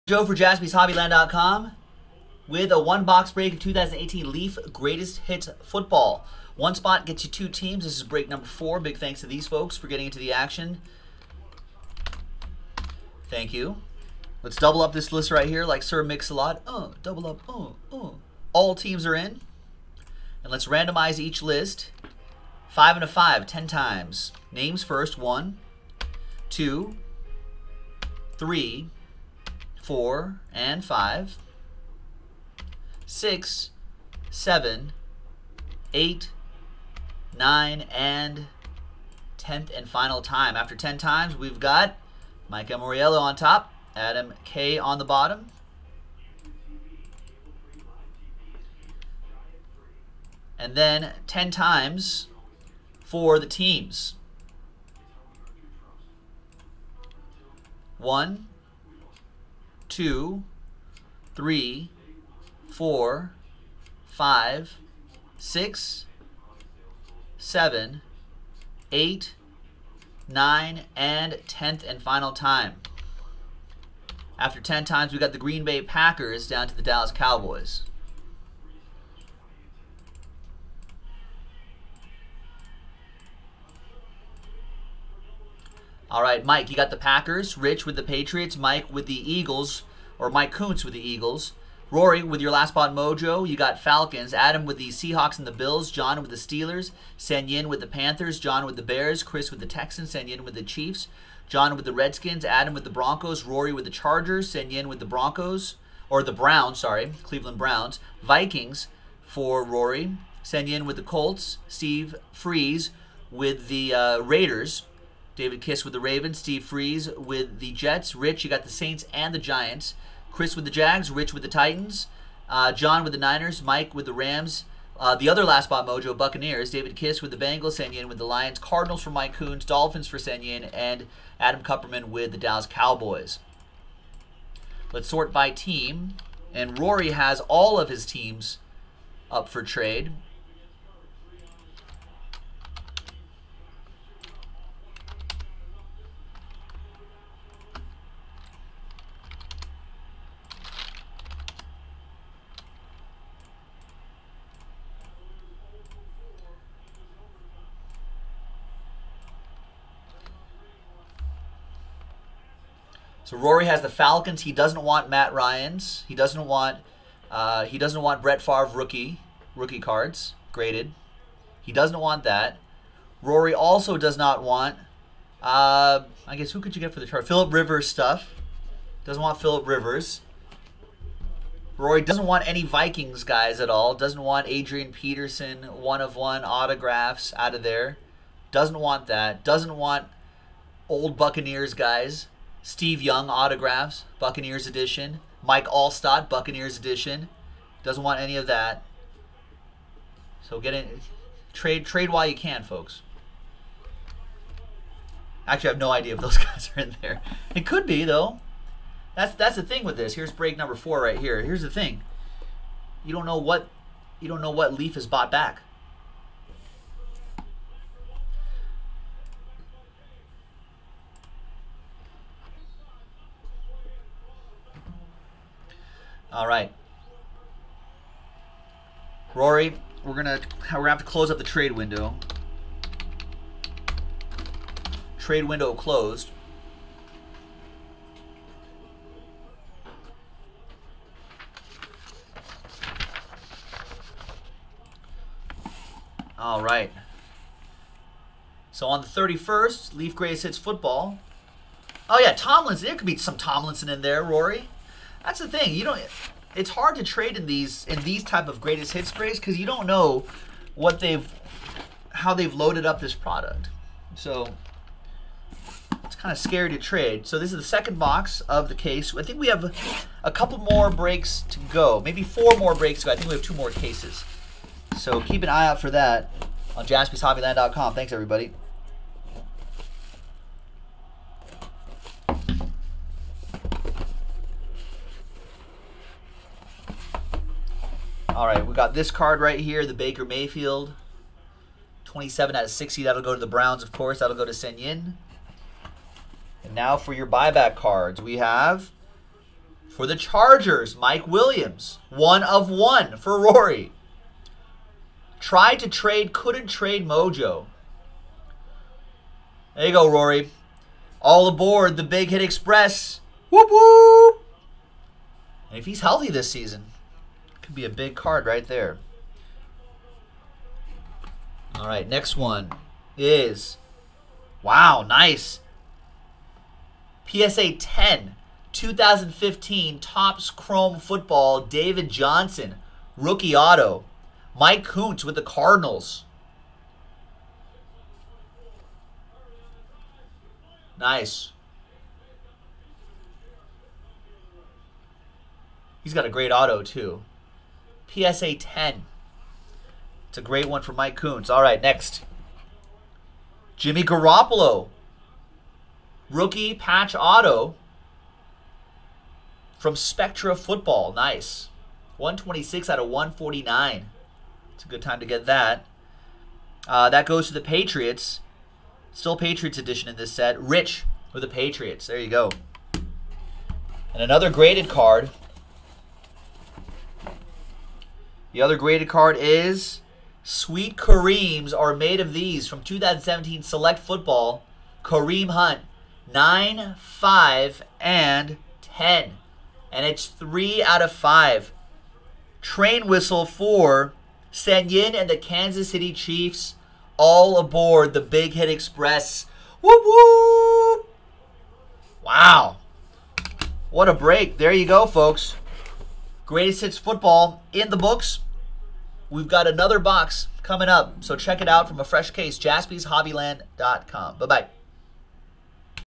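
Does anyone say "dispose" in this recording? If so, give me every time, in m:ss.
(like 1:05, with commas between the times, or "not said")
not said.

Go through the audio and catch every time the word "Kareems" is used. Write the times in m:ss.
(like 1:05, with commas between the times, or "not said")
6:20, 6:25.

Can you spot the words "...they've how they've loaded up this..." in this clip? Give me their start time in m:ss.
4:20.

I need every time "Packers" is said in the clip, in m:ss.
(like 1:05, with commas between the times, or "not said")
1:15, 1:26.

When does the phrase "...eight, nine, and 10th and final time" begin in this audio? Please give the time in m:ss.
1:08.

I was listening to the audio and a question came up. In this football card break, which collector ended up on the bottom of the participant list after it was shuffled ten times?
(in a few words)
Adam K.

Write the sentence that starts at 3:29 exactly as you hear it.
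That's that's the thing with this.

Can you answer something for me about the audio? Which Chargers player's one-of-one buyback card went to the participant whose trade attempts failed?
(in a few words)
Mike Williams.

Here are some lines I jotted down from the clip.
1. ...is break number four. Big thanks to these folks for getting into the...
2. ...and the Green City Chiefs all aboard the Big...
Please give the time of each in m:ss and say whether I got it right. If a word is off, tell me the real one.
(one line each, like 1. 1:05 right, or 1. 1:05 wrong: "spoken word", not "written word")
1. 0:07 right
2. 6:35 wrong: "Kansas", not "Green".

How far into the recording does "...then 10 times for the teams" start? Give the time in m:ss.
0:50.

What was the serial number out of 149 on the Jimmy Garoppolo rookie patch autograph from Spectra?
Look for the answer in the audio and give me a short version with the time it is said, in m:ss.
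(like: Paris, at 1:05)
126, at 6:02.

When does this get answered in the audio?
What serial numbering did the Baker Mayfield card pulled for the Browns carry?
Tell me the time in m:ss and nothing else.
4:52.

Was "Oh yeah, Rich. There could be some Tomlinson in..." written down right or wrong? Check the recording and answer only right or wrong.
wrong.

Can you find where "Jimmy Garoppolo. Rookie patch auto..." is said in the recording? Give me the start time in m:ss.
5:53.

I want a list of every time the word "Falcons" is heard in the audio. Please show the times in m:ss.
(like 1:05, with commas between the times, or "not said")
1:33, 2:43.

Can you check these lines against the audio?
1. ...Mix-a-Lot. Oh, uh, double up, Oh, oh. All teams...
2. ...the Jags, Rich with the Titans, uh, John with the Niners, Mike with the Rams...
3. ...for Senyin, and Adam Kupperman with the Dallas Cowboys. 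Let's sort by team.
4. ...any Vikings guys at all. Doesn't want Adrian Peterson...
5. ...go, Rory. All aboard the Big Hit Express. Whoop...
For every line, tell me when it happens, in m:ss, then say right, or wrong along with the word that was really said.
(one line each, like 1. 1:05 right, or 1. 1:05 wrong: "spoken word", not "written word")
1. 0:16 right
2. 2:00 right
3. 2:10 right
4. 3:02 right
5. 5:09 right.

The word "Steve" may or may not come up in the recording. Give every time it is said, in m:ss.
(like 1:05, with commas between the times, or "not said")
1:51, 1:56, 3:12.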